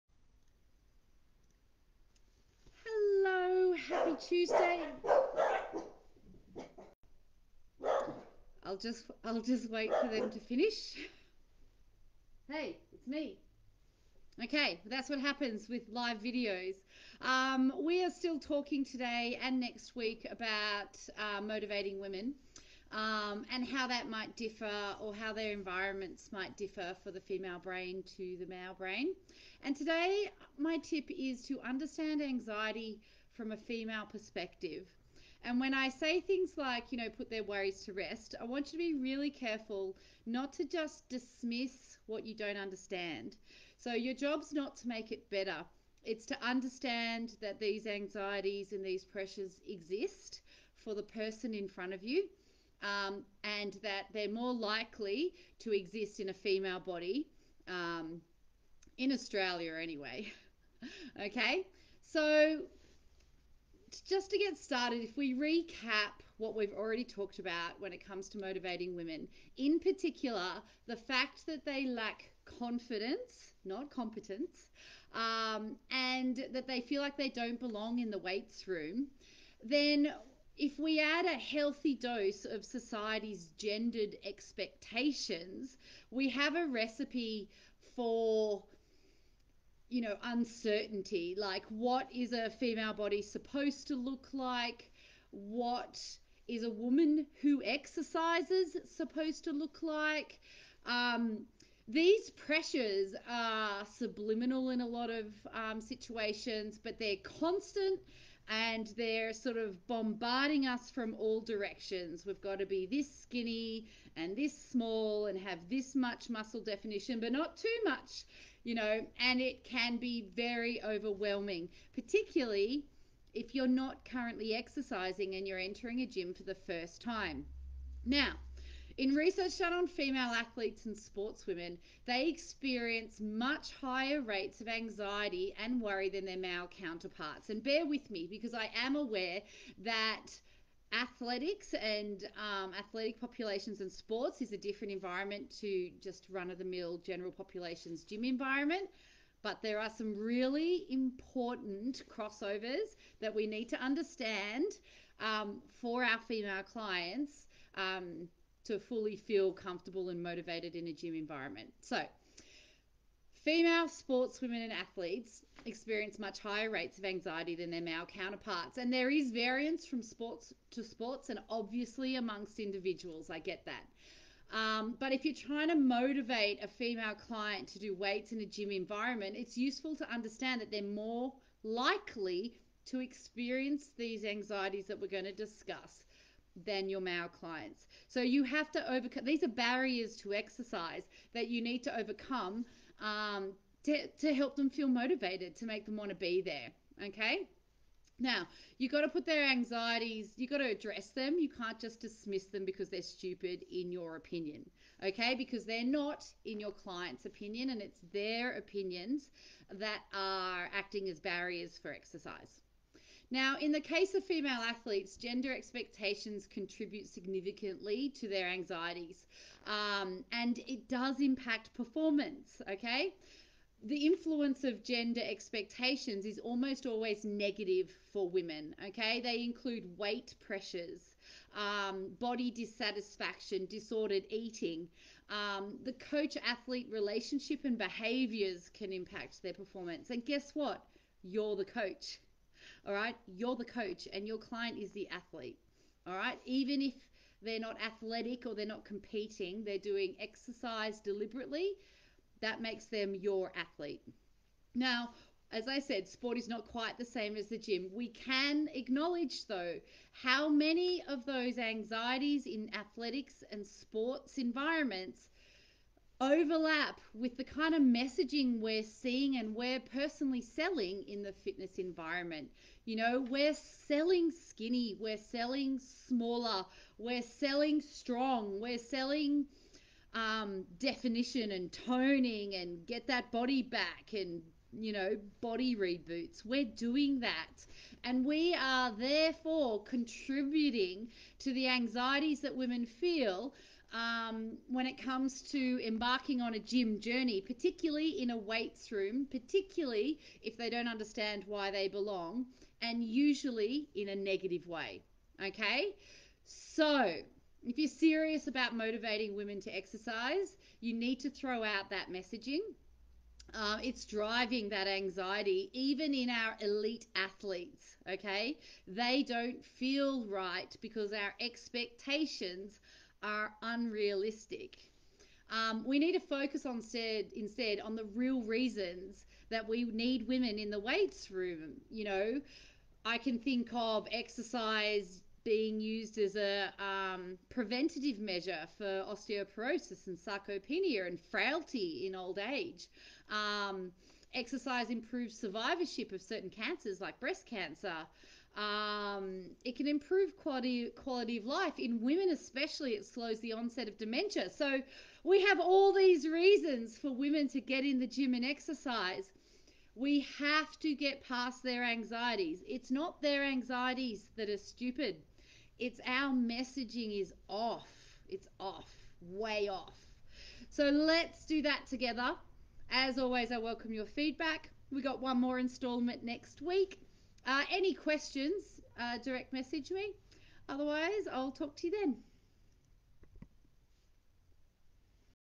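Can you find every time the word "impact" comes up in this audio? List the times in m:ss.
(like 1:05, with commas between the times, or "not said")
3:41, 3:58.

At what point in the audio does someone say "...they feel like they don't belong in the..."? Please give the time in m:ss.
1:16.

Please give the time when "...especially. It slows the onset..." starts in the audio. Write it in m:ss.
5:52.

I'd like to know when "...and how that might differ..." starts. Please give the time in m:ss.
0:23.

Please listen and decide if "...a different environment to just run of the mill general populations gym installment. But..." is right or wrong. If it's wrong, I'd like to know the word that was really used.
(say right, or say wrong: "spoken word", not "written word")
wrong: "environment", not "installment".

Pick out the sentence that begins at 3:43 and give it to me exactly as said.
The influence of gender expectations is almost always negative for women, okay?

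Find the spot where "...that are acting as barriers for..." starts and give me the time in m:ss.
3:29.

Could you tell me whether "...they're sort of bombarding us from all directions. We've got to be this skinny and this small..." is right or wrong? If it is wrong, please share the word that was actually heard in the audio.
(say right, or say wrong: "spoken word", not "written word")
right.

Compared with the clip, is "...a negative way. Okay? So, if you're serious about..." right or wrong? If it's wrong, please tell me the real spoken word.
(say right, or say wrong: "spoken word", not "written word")
right.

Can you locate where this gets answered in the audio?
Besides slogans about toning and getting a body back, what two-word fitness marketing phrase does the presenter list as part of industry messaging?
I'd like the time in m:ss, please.
4:45.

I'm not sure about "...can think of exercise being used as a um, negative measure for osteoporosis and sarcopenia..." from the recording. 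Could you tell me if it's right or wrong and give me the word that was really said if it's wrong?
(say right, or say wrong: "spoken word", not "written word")
wrong: "preventative", not "negative".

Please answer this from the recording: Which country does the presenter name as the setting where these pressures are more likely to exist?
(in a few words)
Australia.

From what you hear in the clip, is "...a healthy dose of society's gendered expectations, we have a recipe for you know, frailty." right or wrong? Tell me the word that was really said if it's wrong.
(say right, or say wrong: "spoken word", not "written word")
wrong: "uncertainty", not "frailty".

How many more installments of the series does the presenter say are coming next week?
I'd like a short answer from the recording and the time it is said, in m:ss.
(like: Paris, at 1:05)
1, at 6:15.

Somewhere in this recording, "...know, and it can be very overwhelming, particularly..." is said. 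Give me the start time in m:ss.
1:58.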